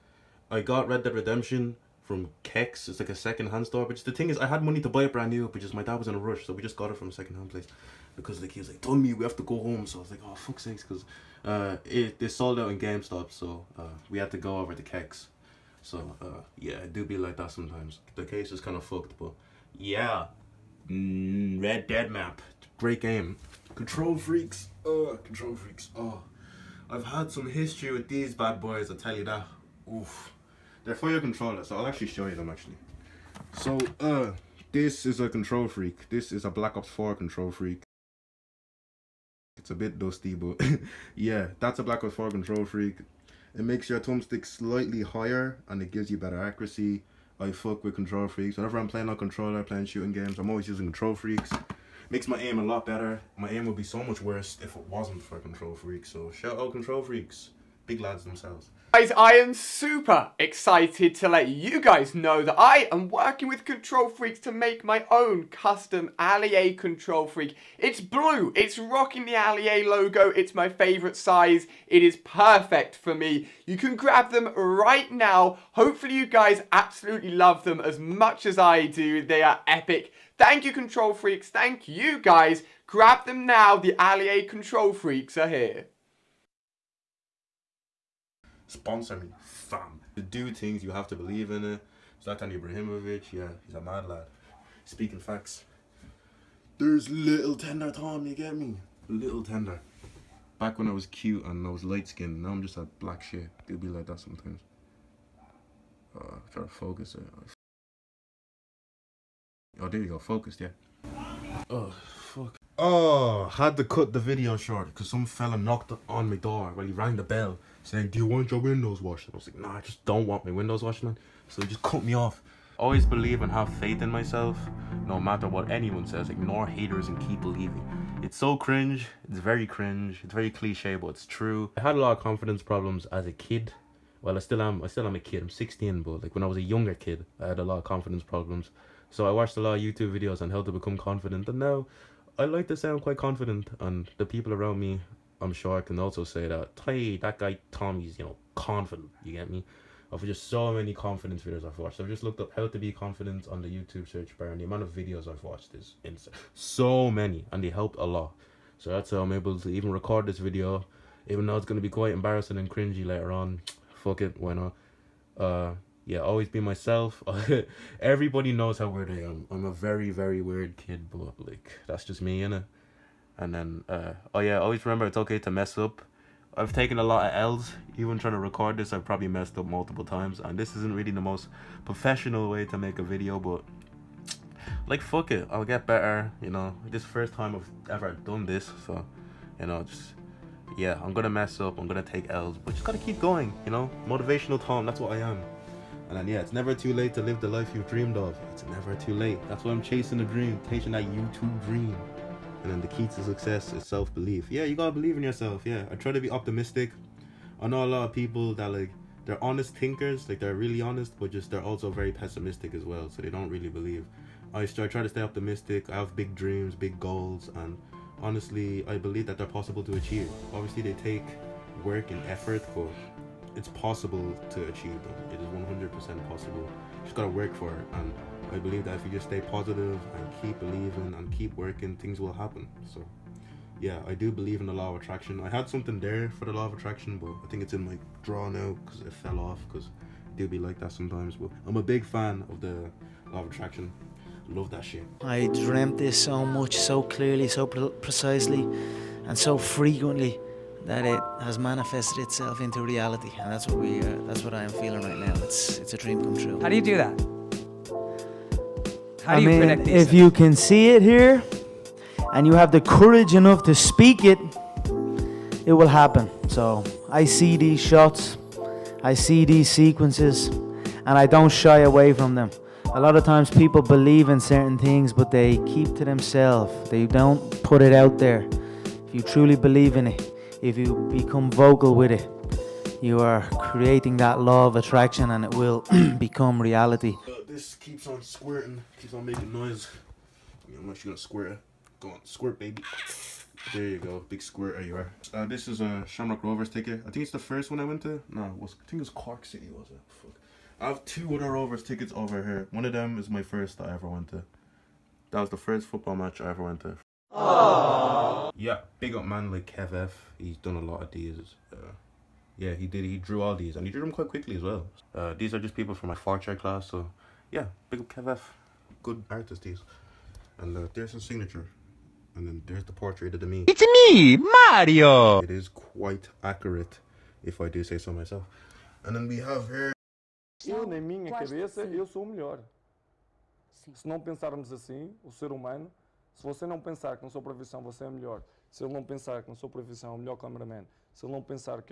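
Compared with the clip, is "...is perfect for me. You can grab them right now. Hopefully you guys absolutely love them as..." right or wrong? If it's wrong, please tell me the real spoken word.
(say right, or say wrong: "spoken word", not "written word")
right.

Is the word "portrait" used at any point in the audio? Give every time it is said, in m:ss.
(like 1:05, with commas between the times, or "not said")
5:22.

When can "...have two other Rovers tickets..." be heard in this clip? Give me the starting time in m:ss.
5:00.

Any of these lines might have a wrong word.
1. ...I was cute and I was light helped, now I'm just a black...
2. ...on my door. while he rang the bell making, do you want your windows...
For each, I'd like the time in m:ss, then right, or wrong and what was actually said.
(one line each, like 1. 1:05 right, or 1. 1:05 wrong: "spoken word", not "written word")
1. 1:40 wrong: "skinned", not "helped"
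2. 1:56 wrong: "saying", not "making".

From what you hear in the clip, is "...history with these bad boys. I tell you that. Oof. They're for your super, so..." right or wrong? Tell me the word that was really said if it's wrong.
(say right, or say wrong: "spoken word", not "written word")
wrong: "controller", not "super".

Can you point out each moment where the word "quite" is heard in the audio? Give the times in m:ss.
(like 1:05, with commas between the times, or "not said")
2:23, 2:41, 5:14, 5:25.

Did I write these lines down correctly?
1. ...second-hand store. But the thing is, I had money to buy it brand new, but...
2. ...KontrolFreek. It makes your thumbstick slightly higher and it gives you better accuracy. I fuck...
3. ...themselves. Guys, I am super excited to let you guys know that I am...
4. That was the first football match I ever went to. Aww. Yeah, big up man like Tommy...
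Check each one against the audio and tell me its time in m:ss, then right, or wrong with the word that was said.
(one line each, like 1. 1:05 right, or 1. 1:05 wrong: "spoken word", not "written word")
1. 0:03 right
2. 0:42 right
3. 0:58 right
4. 5:05 wrong: "Kev", not "Tommy".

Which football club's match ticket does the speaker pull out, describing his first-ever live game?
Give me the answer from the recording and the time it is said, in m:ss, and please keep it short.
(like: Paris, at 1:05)
Shamrock Rovers, at 4:56.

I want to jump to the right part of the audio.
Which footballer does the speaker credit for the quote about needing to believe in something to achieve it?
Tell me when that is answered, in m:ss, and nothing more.
1:32.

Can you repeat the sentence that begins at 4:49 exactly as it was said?
I mean, I'm actually gonna squirt.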